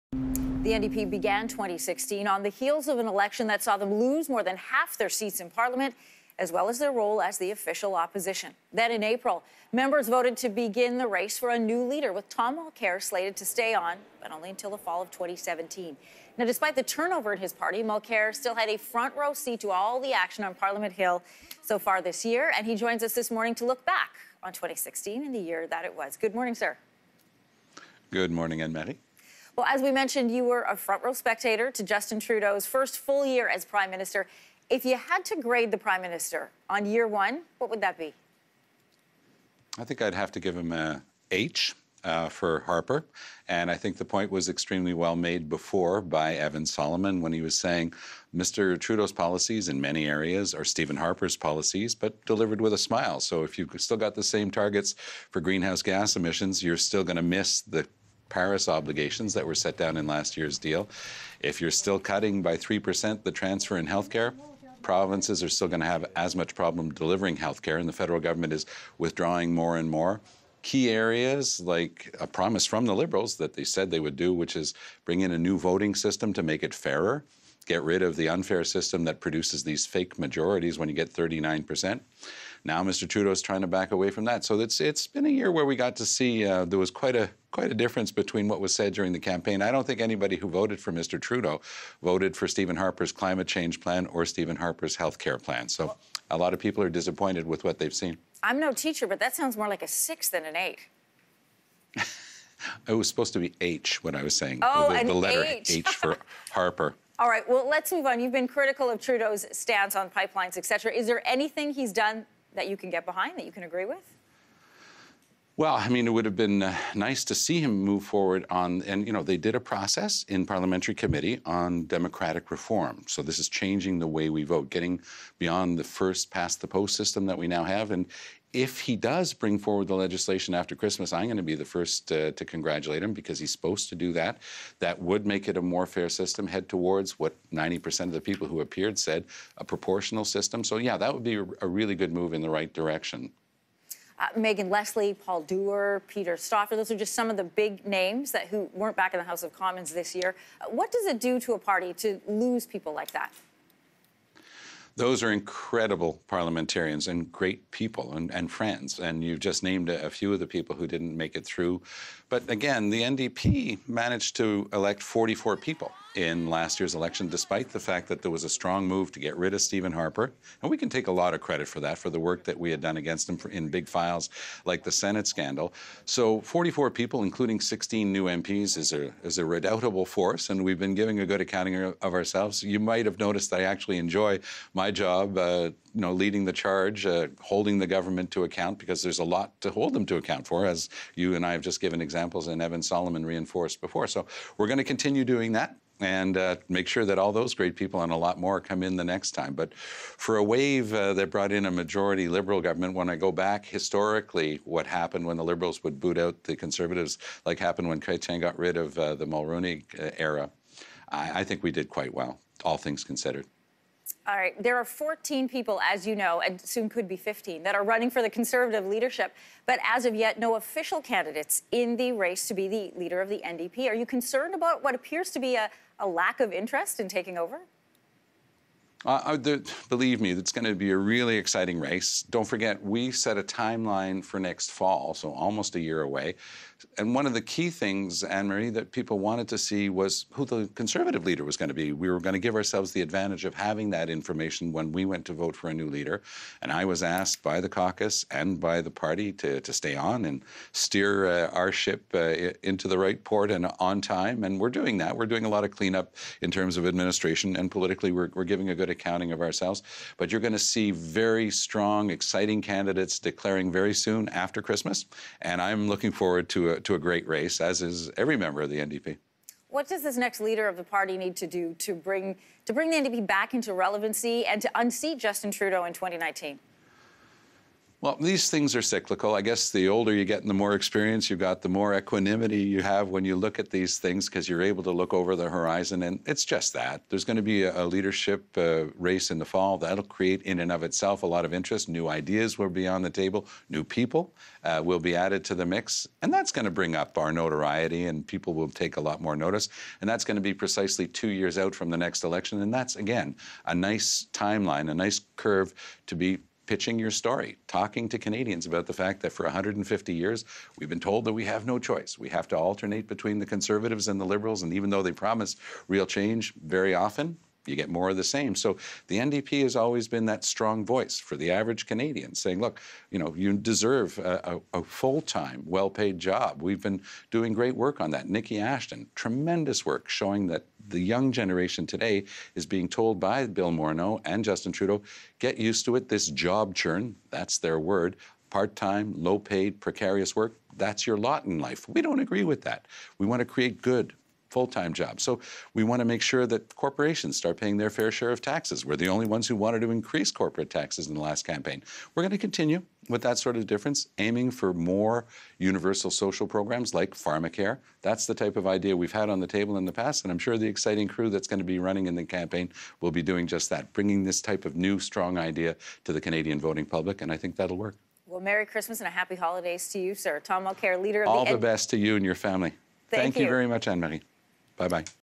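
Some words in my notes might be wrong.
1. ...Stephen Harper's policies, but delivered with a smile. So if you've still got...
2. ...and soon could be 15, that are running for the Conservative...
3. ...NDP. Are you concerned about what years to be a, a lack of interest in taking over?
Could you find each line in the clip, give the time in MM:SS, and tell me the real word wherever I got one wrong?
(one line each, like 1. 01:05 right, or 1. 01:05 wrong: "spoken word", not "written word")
1. 00:50 right
2. 03:36 right
3. 03:43 wrong: "appears", not "years".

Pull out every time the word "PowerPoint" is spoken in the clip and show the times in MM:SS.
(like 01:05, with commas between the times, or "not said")
not said.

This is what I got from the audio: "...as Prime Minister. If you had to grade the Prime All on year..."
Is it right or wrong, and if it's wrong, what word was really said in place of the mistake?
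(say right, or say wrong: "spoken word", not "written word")
wrong: "Minister", not "All".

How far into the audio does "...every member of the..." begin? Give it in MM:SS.
04:28.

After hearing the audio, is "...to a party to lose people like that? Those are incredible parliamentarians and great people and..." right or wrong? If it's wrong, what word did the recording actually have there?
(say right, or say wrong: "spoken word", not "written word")
right.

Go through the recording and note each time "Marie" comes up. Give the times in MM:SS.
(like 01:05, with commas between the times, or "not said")
00:28, 03:58, 06:13.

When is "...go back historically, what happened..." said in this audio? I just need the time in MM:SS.
03:23.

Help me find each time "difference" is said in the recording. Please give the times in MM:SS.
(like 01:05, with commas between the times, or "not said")
01:27, 05:53.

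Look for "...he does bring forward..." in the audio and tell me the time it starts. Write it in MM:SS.
02:08.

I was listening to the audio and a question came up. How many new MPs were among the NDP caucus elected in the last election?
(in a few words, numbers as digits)
16.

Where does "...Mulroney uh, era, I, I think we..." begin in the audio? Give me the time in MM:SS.
03:29.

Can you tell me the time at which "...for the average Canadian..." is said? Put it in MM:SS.
05:21.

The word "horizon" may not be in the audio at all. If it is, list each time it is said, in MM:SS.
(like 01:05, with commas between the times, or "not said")
04:45.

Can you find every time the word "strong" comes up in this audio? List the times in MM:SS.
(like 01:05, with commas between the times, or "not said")
02:48, 04:21, 05:20, 06:04.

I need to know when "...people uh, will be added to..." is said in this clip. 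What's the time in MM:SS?
04:53.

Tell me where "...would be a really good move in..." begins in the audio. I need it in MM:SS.
02:21.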